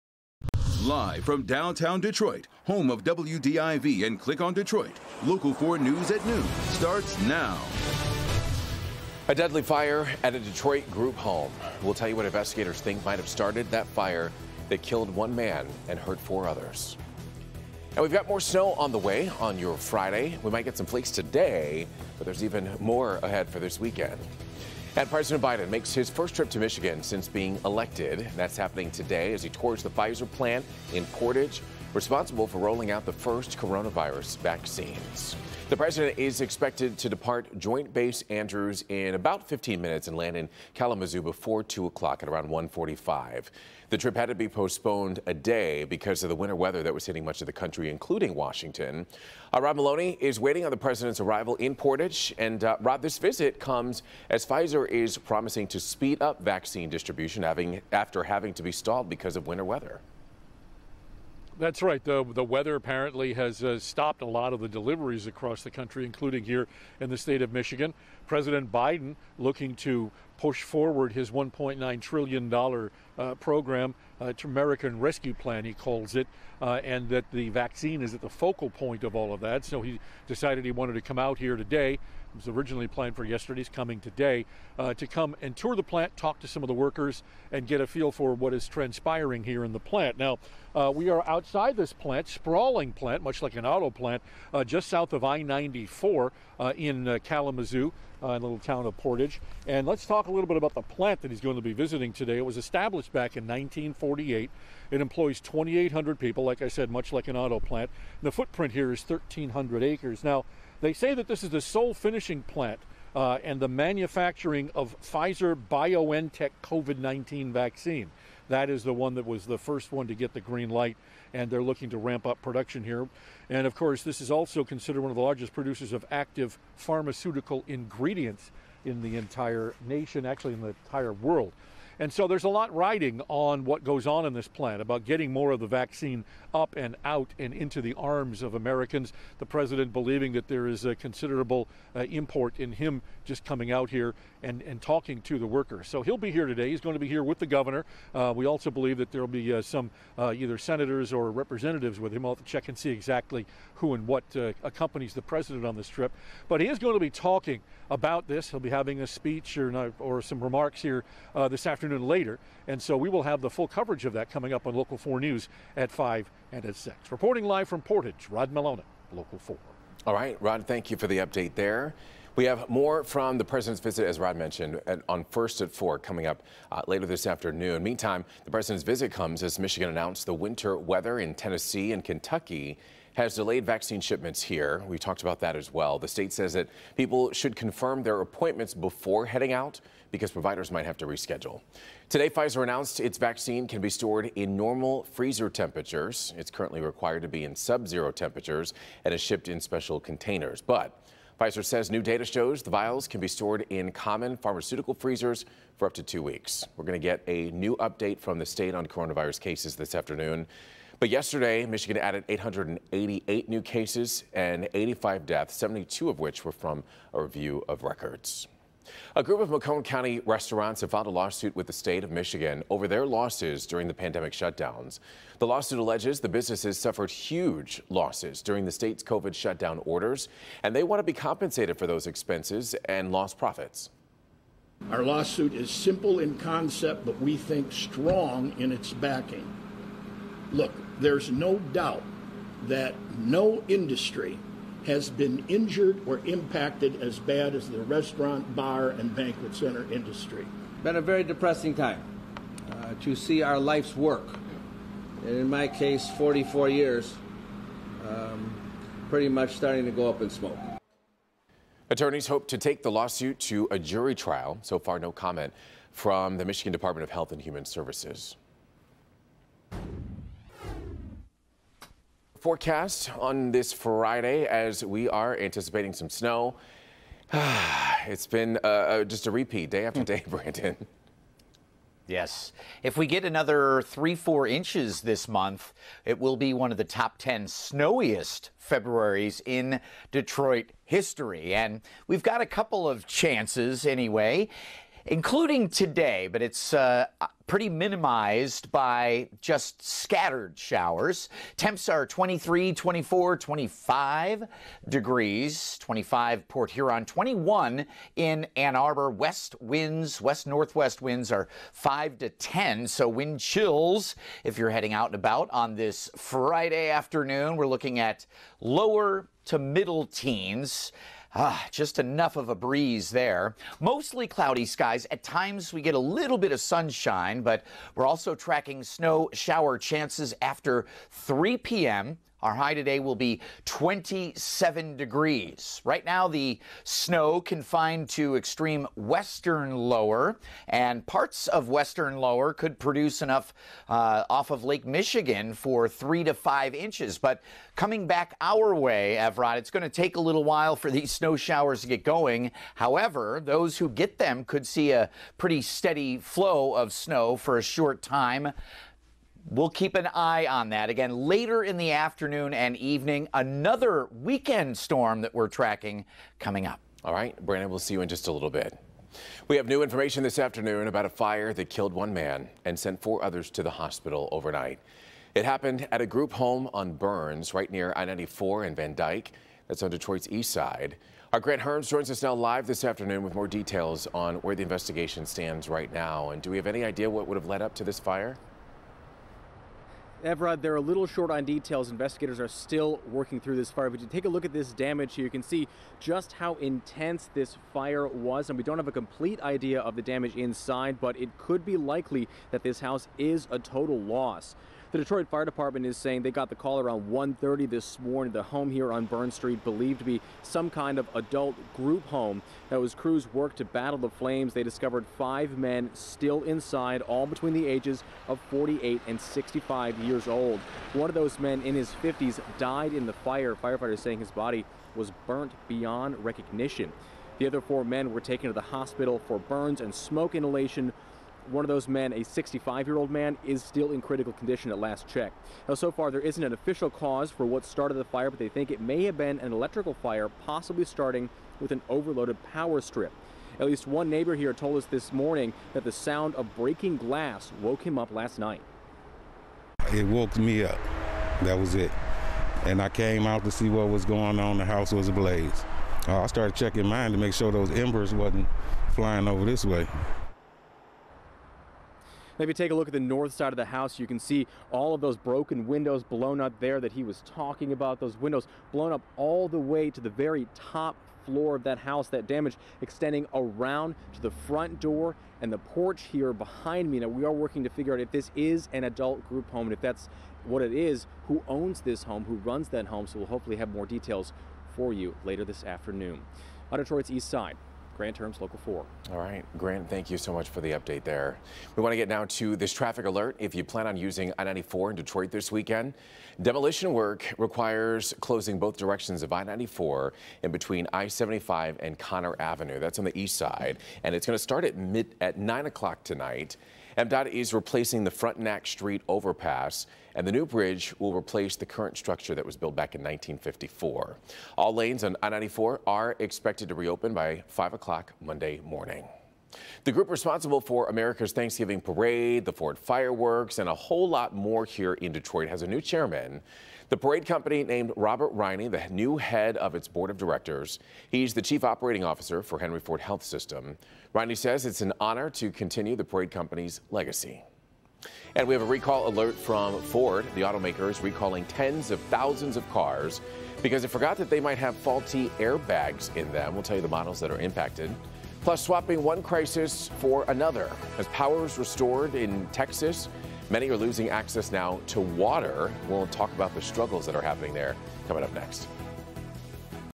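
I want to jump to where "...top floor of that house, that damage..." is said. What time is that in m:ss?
7:50.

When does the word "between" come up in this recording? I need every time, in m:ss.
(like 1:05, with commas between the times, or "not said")
6:57, 8:20.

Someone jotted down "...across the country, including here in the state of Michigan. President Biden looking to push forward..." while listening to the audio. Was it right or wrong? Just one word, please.
right.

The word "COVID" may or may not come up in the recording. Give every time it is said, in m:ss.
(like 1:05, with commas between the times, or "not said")
1:56, 3:49.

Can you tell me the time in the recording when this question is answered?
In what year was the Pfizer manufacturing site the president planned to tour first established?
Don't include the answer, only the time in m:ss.
1:43.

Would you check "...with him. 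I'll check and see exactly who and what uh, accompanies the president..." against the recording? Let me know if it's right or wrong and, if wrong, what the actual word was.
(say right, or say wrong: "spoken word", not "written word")
right.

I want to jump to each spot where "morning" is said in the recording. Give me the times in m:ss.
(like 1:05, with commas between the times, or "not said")
6:47, 7:25, 8:38.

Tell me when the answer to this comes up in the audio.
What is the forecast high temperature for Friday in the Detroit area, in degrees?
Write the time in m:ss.
5:33.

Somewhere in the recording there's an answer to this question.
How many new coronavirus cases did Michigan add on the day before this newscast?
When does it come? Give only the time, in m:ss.
3:32.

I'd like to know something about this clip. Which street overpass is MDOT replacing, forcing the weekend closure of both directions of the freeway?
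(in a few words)
Frontenac Street.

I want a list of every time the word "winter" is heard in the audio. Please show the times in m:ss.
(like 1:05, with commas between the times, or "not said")
0:46, 0:59, 3:00.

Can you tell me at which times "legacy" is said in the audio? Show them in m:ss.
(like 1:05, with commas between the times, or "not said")
8:56.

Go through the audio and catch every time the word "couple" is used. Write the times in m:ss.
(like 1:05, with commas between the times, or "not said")
4:52.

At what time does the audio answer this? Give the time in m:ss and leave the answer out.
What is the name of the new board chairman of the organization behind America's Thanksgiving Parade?
8:47.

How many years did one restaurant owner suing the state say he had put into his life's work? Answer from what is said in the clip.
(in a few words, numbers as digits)
44 years.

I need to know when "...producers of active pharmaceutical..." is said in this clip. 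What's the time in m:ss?
2:05.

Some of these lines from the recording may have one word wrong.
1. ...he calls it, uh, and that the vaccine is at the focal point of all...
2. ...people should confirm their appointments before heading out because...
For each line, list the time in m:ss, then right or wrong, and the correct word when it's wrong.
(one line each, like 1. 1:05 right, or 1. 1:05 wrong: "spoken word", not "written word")
1. 1:15 right
2. 3:06 right.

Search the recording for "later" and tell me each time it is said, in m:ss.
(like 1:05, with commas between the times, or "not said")
2:42, 2:56, 6:01, 8:05.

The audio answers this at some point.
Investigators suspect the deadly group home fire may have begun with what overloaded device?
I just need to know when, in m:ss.
7:22.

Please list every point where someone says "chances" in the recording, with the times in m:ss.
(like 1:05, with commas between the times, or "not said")
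4:53, 5:29.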